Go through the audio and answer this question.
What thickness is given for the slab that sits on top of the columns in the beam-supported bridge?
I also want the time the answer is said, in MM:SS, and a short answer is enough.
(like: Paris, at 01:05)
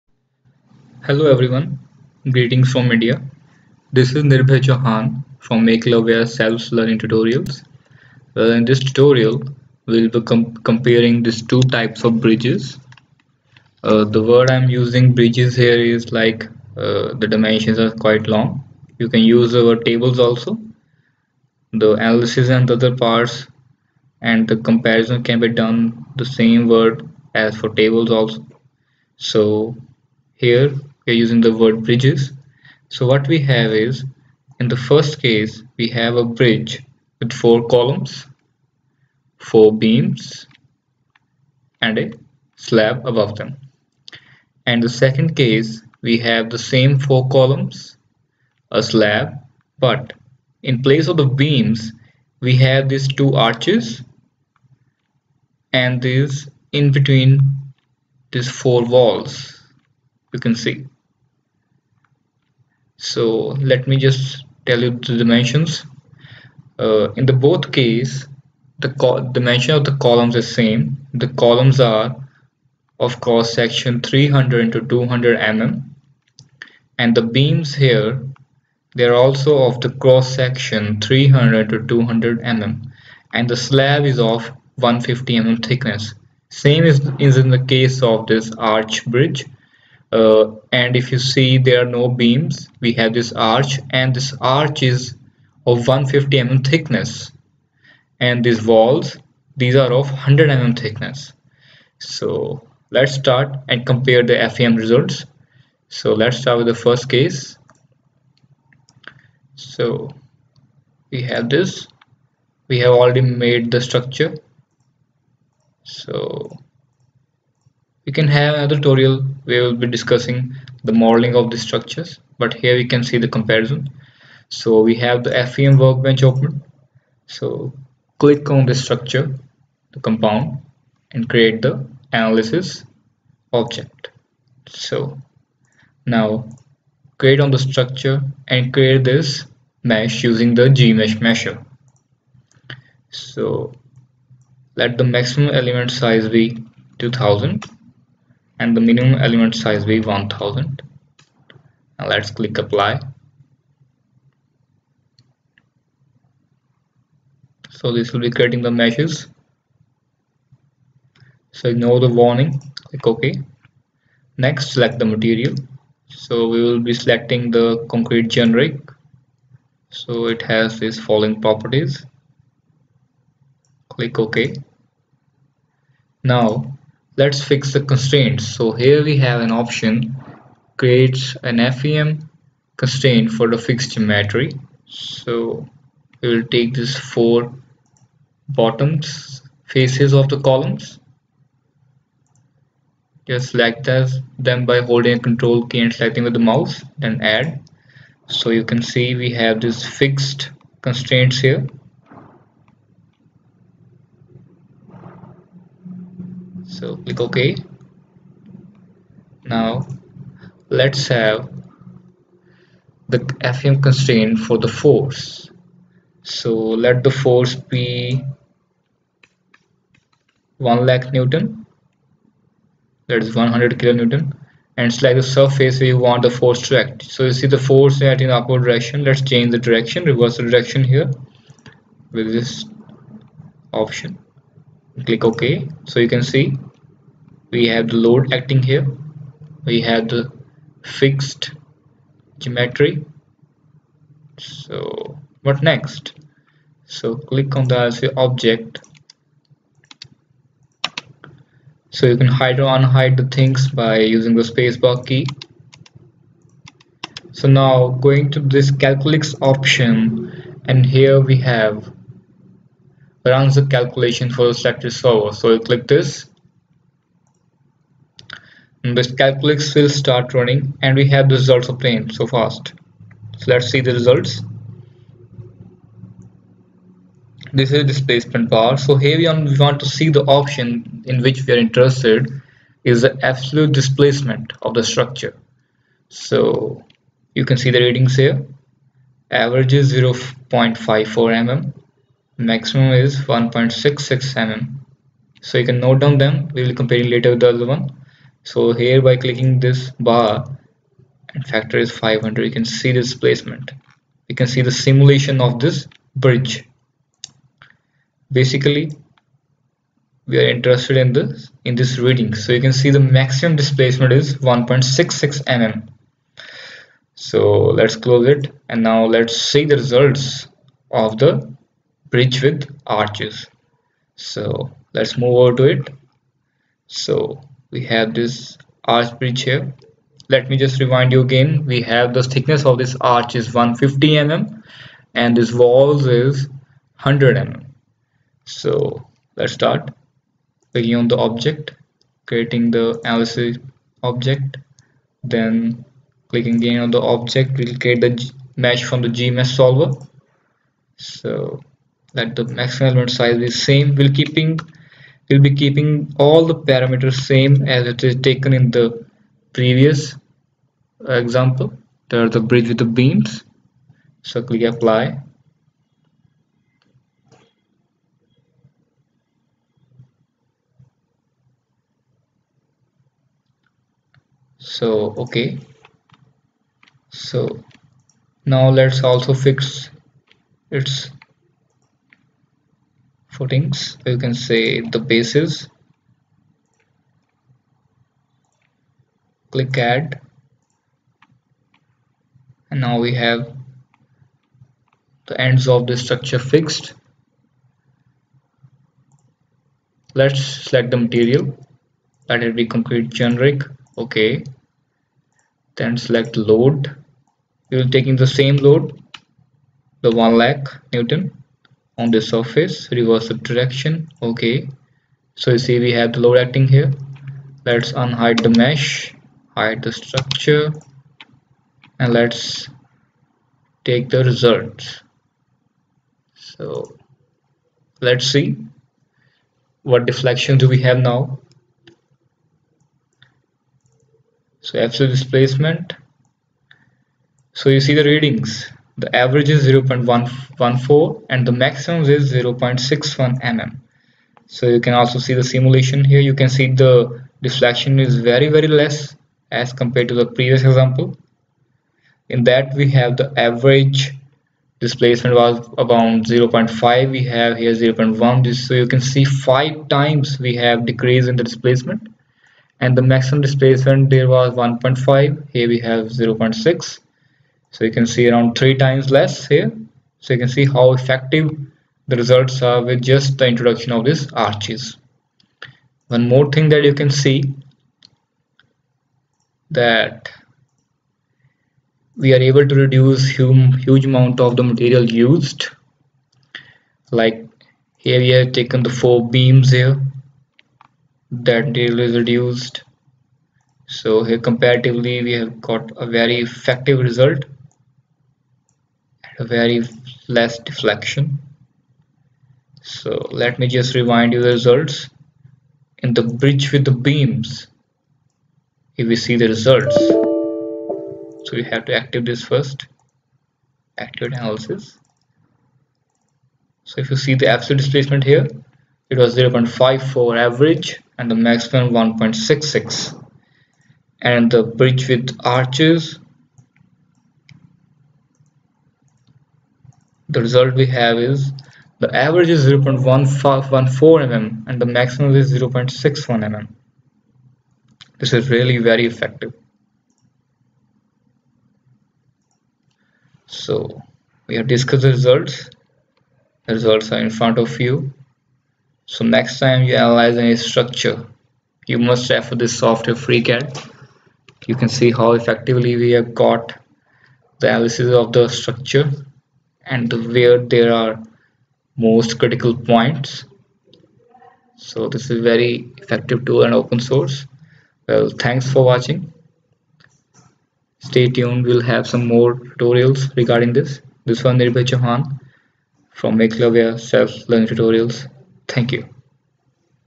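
150 mm, at 01:23.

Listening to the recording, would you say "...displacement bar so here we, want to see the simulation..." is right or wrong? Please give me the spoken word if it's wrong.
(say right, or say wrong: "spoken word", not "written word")
wrong: "option", not "simulation".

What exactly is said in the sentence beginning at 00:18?
You can use our tables also.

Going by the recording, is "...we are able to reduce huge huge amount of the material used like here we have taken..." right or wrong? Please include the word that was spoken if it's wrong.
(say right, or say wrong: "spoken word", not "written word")
right.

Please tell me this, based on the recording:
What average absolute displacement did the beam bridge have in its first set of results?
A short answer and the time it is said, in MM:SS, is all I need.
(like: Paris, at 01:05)
0.54 mm, at 04:49.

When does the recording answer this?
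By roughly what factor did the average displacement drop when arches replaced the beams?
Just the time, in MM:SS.
07:39.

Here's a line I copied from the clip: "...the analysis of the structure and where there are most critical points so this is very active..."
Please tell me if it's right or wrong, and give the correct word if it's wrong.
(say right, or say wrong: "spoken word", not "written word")
wrong: "effective", not "active".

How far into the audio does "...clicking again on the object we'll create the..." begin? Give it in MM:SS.
05:46.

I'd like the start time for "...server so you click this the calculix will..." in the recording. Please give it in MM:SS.
04:24.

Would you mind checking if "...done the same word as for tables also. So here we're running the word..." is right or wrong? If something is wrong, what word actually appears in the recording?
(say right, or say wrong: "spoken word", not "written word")
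wrong: "using", not "running".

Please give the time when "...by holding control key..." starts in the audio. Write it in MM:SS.
03:14.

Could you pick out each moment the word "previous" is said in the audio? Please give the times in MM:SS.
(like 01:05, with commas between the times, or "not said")
05:59, 07:30.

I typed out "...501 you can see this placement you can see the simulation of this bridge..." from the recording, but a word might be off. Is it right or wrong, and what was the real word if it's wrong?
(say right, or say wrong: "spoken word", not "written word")
wrong: "500", not "501".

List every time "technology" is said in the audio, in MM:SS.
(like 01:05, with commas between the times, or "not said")
not said.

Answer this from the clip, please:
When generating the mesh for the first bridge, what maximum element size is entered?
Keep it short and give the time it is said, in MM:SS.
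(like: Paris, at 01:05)
2000, at 02:26.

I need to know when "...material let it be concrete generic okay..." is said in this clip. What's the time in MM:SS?
06:41.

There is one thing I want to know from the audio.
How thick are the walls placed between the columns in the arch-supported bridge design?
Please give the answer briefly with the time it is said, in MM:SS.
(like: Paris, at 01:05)
100 mm, at 01:38.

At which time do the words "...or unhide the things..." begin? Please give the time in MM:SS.
04:12.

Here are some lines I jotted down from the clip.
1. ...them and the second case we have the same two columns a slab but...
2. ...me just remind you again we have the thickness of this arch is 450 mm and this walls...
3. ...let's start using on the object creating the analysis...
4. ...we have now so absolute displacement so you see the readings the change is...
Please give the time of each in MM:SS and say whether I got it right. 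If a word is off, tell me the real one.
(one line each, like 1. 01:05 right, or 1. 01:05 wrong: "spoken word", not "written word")
1. 00:43 wrong: "four", not "two"
2. 05:30 wrong: "150", not "450"
3. 05:39 wrong: "clicking", not "using"
4. 07:10 wrong: "average", not "change".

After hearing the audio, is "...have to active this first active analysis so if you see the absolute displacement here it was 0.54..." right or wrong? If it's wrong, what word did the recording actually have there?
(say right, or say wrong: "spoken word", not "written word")
right.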